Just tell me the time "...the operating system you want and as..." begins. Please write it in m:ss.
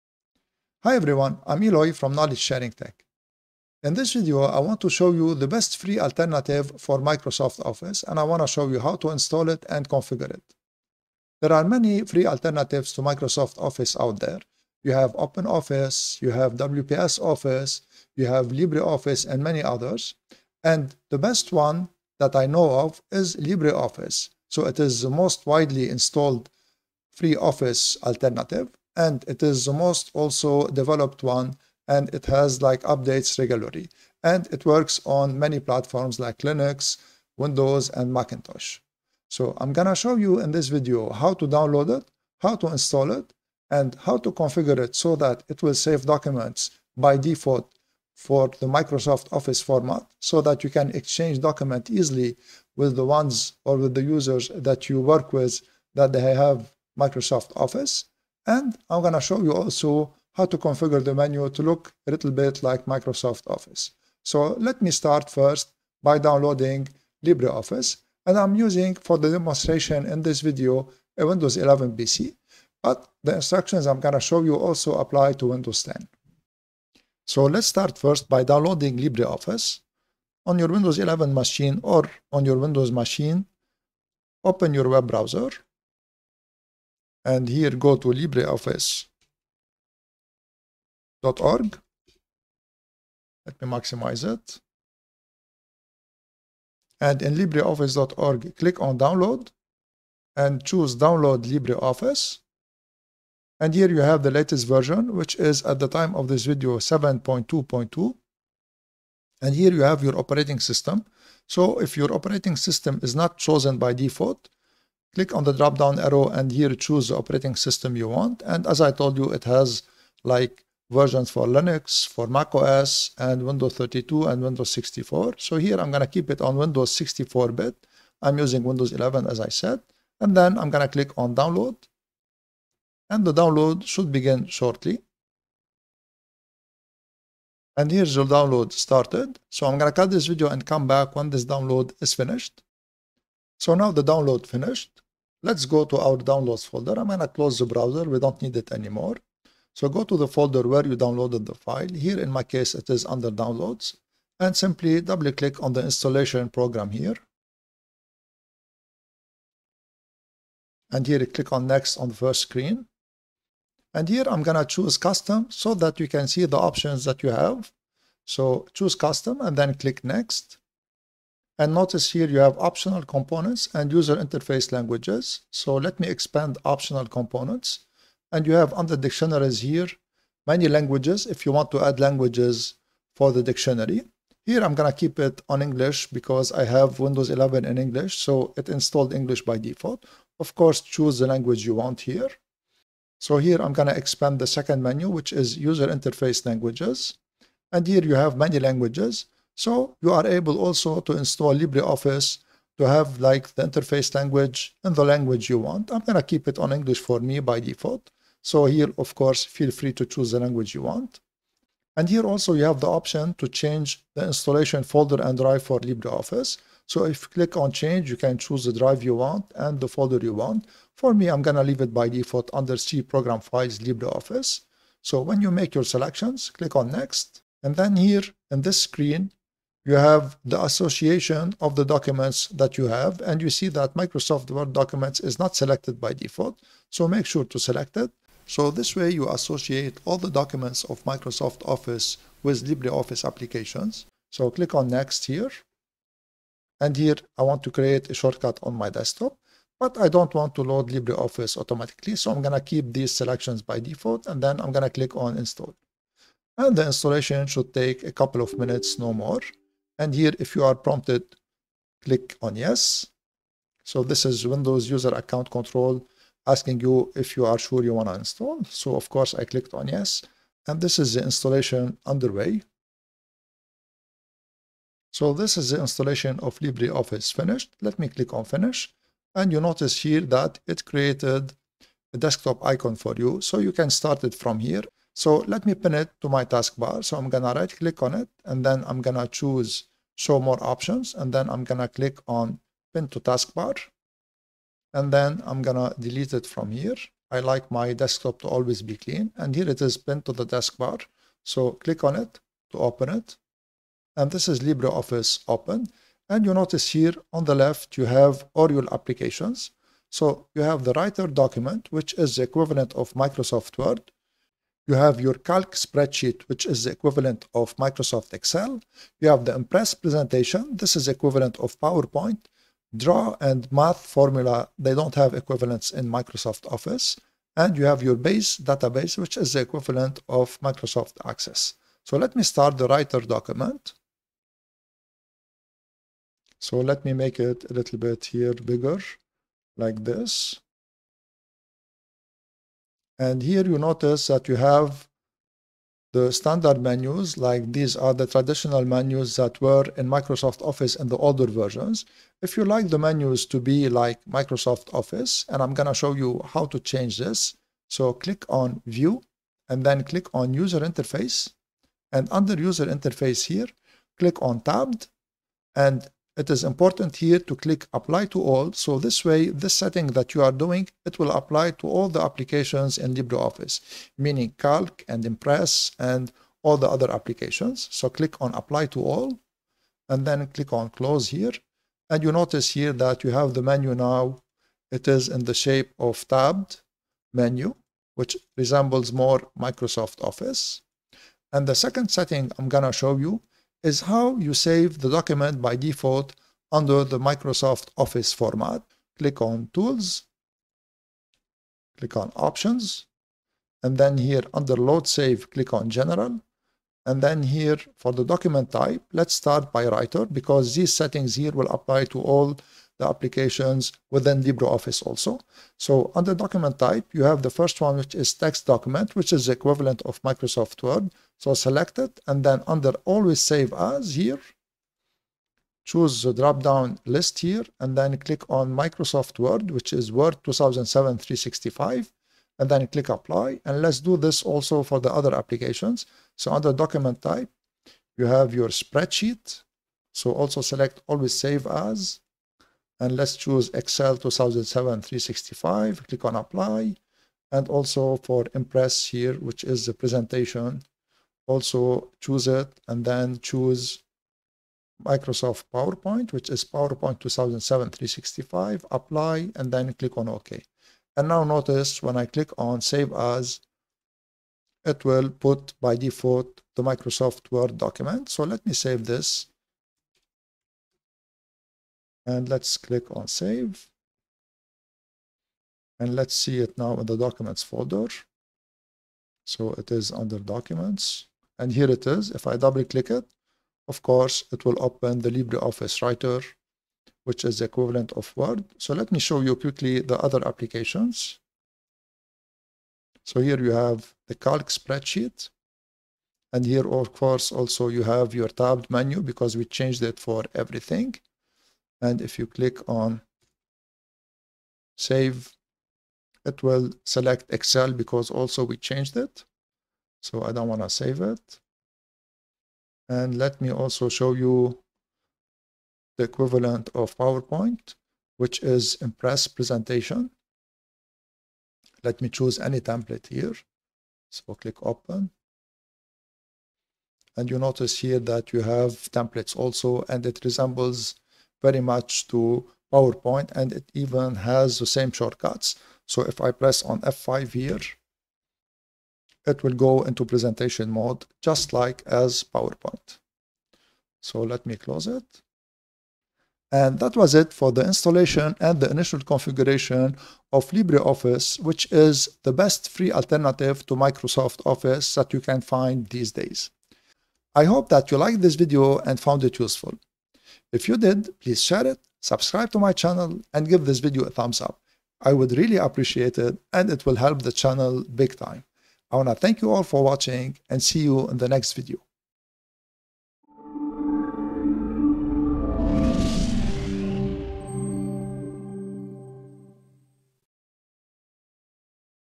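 1:57.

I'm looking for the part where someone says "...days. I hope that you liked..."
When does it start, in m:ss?
9:16.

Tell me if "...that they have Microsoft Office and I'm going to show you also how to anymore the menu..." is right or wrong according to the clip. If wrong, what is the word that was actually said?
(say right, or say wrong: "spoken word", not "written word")
wrong: "configure", not "anymore".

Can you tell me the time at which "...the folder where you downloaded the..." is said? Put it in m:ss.
2:30.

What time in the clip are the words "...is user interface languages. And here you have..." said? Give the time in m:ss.
3:15.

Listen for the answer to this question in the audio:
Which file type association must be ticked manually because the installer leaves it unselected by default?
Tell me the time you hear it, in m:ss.
3:53.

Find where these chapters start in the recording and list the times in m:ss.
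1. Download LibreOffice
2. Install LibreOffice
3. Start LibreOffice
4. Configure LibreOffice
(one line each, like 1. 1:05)
1. 1:16
2. 2:23
3. 4:39
4. 5:31.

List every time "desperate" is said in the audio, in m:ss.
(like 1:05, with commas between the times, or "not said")
not said.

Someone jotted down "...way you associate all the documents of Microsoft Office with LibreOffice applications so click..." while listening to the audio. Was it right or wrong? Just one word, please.
right.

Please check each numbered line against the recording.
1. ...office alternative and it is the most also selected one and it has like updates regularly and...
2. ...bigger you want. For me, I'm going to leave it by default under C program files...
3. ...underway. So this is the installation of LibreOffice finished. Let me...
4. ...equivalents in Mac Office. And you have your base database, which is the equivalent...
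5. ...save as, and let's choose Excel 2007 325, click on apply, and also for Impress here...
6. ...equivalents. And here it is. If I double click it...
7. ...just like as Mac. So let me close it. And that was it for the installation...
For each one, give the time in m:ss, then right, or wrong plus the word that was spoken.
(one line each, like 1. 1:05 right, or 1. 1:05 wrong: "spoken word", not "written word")
1. 0:27 wrong: "developed", not "selected"
2. 3:39 wrong: "folder", not "bigger"
3. 4:32 right
4. 5:25 wrong: "Microsoft", not "Mac"
5. 7:21 wrong: "365", not "325"
6. 8:00 wrong: "documents", not "equivalents"
7. 9:01 wrong: "PowerPoint", not "Mac".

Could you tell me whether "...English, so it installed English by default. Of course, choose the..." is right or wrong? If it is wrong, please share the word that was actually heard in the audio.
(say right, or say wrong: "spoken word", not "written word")
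right.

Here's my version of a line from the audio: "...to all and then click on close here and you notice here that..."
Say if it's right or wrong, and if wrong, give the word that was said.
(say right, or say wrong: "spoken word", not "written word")
right.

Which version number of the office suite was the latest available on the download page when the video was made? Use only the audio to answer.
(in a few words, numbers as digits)
7.2.2.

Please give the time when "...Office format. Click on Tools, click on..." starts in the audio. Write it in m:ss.
6:37.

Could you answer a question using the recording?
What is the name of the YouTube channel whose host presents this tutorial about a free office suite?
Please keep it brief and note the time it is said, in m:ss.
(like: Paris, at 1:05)
Knowledge Sharing Tech, at 0:02.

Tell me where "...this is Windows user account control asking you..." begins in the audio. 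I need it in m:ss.
4:24.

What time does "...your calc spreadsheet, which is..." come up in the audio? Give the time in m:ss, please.
5:15.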